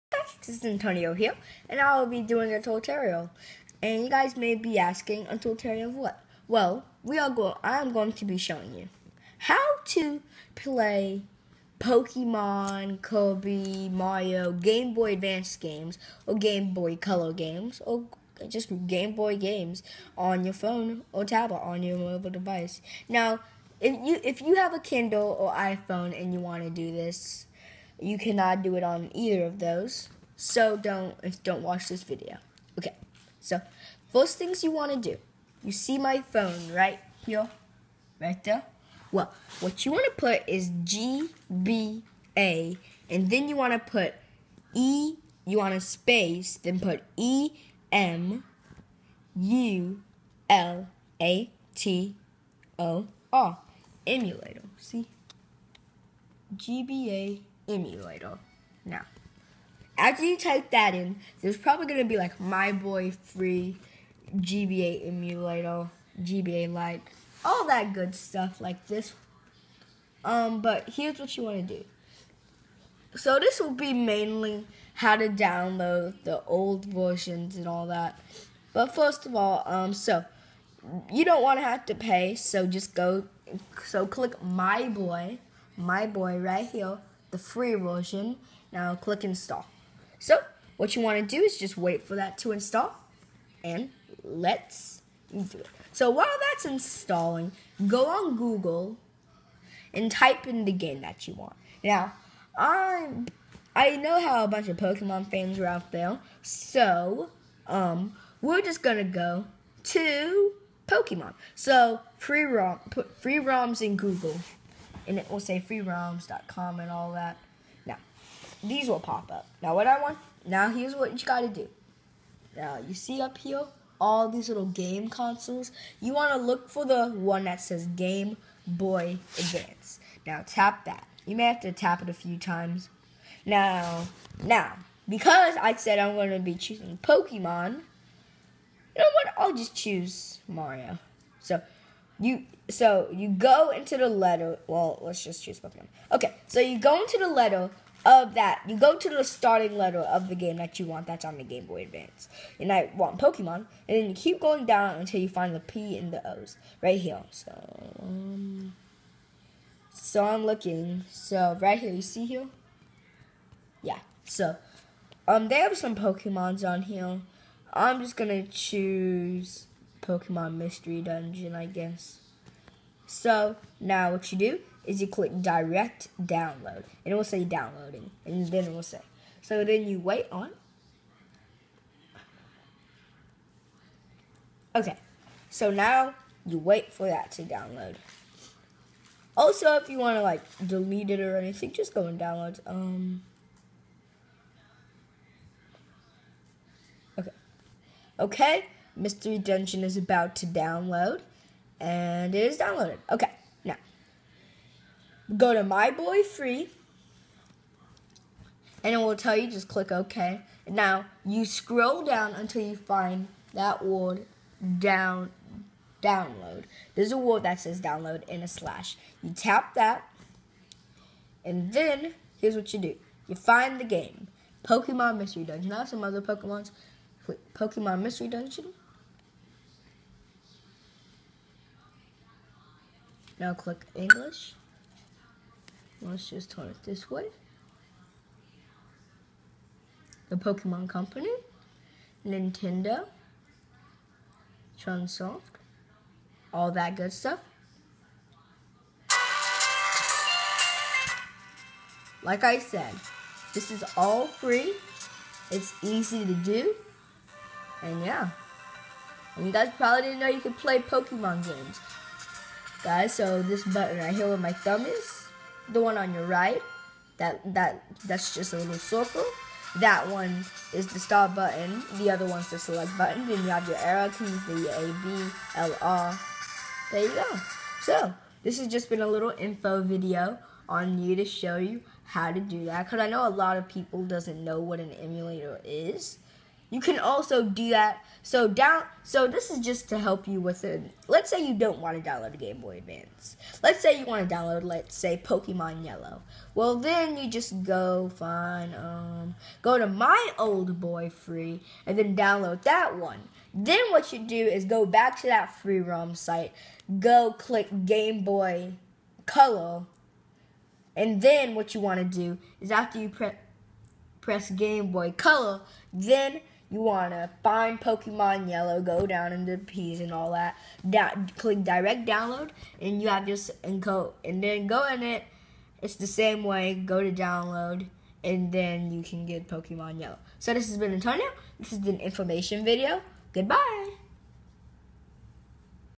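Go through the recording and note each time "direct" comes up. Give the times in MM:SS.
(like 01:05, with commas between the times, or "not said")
02:55, 05:21.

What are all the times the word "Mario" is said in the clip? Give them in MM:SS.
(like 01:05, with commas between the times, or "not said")
00:13, 02:20.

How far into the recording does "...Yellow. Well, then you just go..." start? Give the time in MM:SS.
04:55.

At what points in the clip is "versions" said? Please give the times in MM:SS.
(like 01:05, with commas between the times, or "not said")
01:16, 01:27.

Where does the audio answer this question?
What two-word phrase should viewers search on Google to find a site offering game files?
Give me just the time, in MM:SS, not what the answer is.
01:52.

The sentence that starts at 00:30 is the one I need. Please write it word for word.
So don't don't watch this video.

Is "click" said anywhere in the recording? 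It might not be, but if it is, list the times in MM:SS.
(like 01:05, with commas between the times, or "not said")
01:24, 01:28, 02:55, 03:29, 03:53, 05:07, 05:21.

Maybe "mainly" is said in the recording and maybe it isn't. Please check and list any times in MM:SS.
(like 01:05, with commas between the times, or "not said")
01:13.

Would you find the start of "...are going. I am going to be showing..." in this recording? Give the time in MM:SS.
00:07.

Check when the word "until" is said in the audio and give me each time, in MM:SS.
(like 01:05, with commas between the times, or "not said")
02:34, 03:32.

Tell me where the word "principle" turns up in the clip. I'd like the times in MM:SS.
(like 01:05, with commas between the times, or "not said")
not said.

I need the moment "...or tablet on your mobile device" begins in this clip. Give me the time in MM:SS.
00:21.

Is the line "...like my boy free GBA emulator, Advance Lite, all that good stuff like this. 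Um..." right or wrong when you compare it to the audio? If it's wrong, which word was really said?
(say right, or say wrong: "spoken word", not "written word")
wrong: "GBA", not "Advance".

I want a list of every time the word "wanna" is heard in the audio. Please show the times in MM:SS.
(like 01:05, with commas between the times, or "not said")
02:06, 05:16.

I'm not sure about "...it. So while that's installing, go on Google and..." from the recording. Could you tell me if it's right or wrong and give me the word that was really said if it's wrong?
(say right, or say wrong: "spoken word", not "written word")
right.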